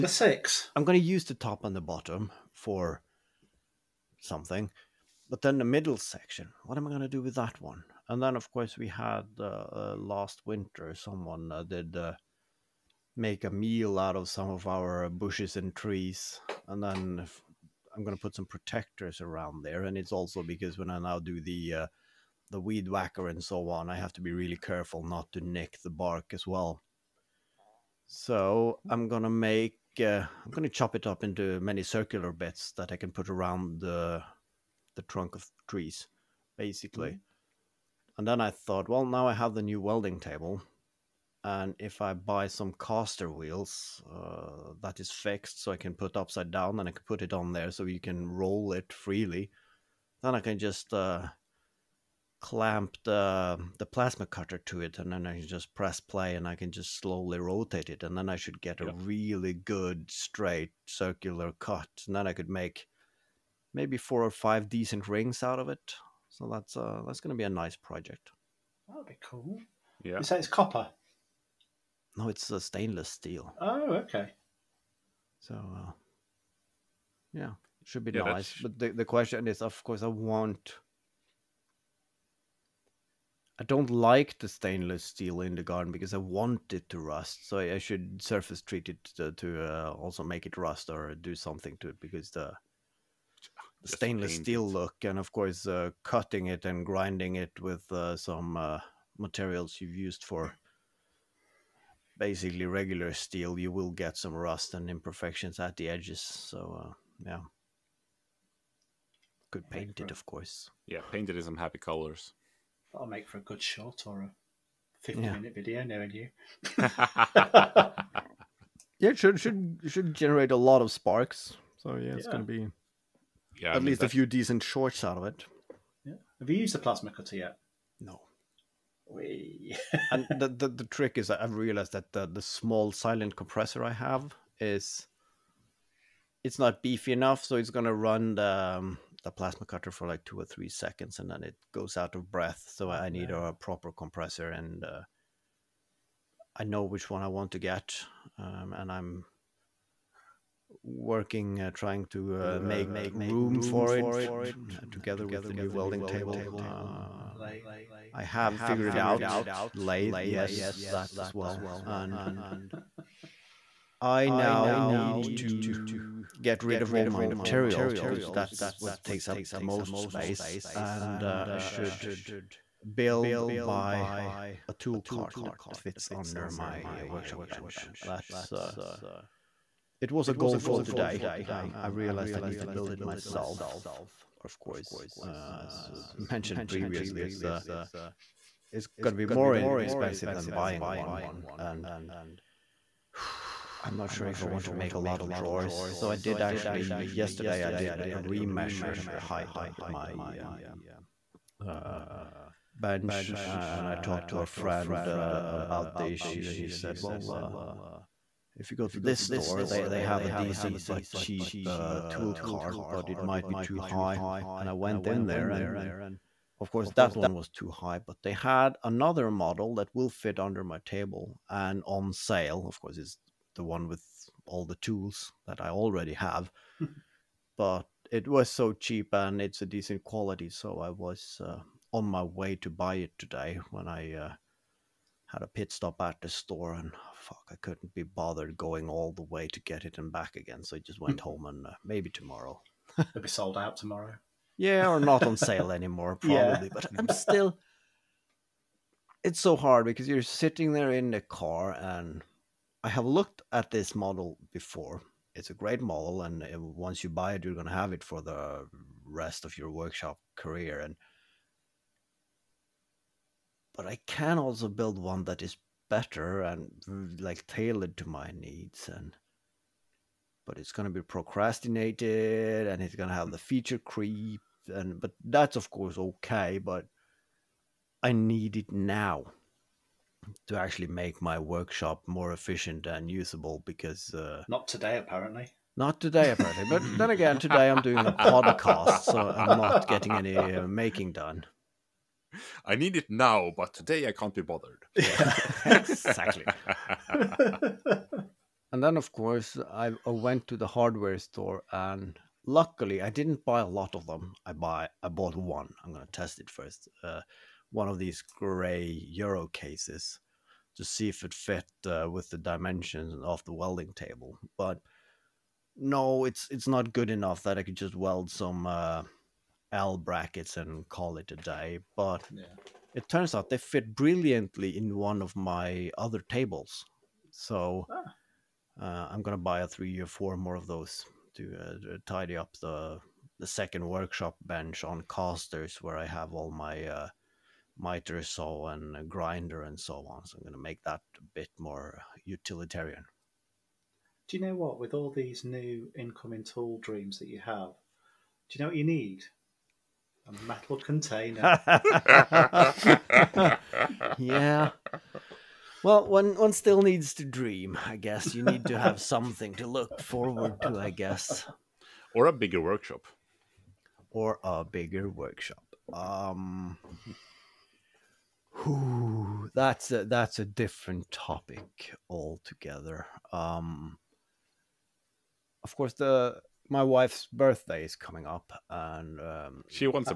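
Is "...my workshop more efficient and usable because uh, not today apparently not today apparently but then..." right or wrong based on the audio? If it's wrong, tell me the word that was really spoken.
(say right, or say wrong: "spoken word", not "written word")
right.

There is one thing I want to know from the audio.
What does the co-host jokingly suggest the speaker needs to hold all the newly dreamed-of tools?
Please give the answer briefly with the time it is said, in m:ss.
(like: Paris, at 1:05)
A metal container, at 5:50.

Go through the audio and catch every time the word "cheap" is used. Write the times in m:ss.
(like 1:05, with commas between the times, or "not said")
3:31, 3:48.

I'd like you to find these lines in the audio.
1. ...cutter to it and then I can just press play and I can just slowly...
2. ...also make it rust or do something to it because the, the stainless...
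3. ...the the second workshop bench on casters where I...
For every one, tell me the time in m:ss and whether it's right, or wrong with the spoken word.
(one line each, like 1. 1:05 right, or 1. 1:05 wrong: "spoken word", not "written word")
1. 0:54 right
2. 1:29 right
3. 5:32 right.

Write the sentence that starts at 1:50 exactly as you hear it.
Yeah, painted in some happy colors.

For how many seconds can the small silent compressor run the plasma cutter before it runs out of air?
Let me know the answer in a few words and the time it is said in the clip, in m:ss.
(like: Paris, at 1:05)
2 or 3 seconds, at 2:20.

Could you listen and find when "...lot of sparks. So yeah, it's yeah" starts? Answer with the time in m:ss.
2:00.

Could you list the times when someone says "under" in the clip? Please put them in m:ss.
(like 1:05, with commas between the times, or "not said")
2:56, 3:19, 3:40.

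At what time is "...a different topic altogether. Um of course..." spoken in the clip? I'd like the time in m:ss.
6:10.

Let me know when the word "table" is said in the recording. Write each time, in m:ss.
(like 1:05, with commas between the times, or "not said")
0:40, 2:36, 3:40, 5:13, 5:26.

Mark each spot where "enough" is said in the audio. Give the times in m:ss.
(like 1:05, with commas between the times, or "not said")
2:17, 5:17.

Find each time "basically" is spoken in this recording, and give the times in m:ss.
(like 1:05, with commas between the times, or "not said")
0:36, 1:42.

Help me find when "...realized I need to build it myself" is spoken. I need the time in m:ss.
3:01.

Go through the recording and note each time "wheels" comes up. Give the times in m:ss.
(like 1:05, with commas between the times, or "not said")
0:43.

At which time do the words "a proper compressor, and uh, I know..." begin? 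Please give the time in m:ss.
2:23.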